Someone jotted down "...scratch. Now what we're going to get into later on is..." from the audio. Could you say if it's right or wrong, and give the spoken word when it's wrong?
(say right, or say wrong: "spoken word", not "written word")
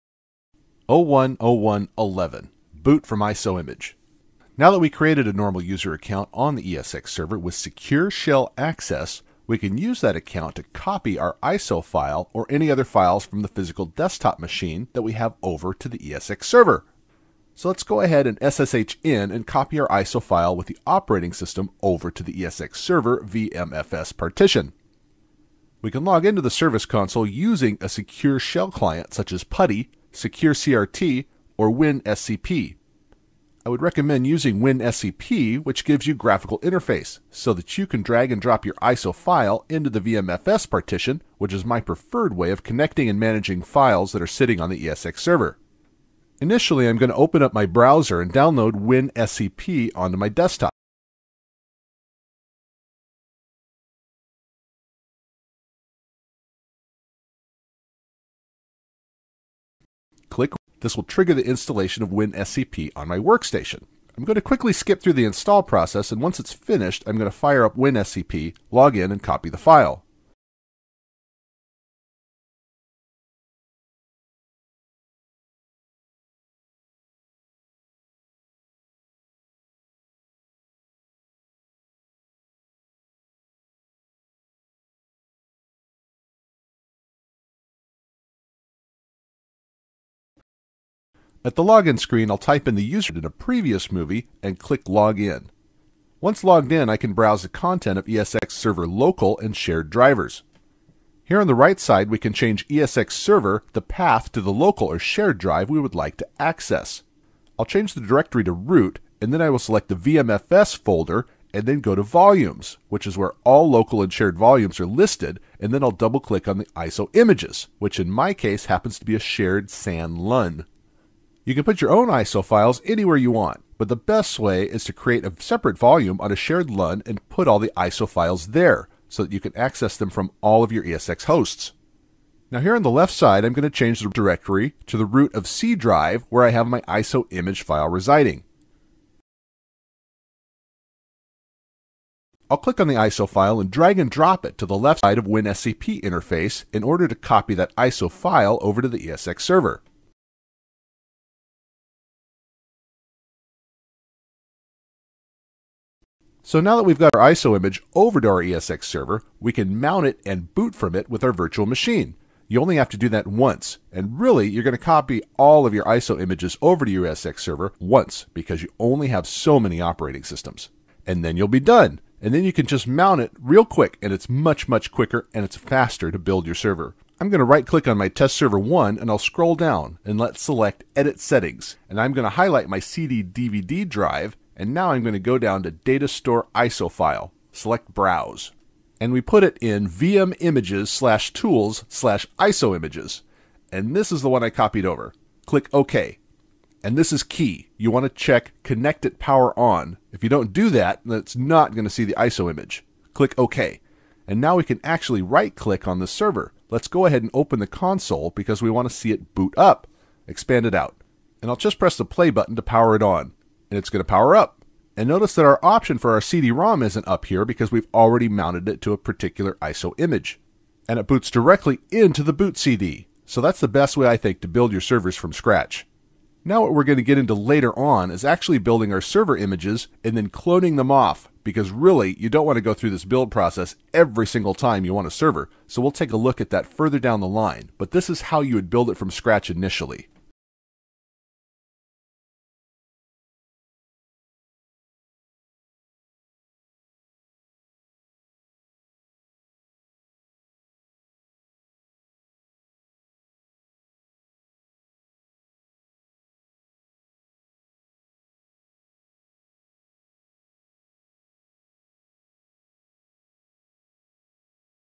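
right.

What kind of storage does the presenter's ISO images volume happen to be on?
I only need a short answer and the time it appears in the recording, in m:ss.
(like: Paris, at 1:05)
shared SAN LUN, at 1:59.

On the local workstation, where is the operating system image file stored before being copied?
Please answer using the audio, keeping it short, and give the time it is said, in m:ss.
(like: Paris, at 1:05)
root of C drive, at 2:15.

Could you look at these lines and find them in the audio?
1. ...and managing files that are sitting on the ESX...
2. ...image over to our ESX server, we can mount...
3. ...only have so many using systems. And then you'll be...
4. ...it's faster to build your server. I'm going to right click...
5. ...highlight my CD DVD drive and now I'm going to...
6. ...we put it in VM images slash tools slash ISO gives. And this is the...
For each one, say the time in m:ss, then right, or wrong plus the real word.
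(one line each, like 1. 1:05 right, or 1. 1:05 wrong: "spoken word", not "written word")
1. 0:43 right
2. 2:37 right
3. 2:48 wrong: "operating", not "using"
4. 2:55 right
5. 3:02 right
6. 3:09 wrong: "images", not "gives".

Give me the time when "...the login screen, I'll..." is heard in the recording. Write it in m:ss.
1:31.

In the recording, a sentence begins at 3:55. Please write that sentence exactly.
So we'll take a look at that further down the line, but this is how you would build it from scratch initially.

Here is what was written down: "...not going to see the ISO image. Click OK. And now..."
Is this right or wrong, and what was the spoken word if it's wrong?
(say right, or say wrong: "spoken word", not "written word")
right.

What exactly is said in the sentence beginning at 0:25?
We can log into the service console using a secure shell client such as PuTTY SecureCRT, or WinSCP.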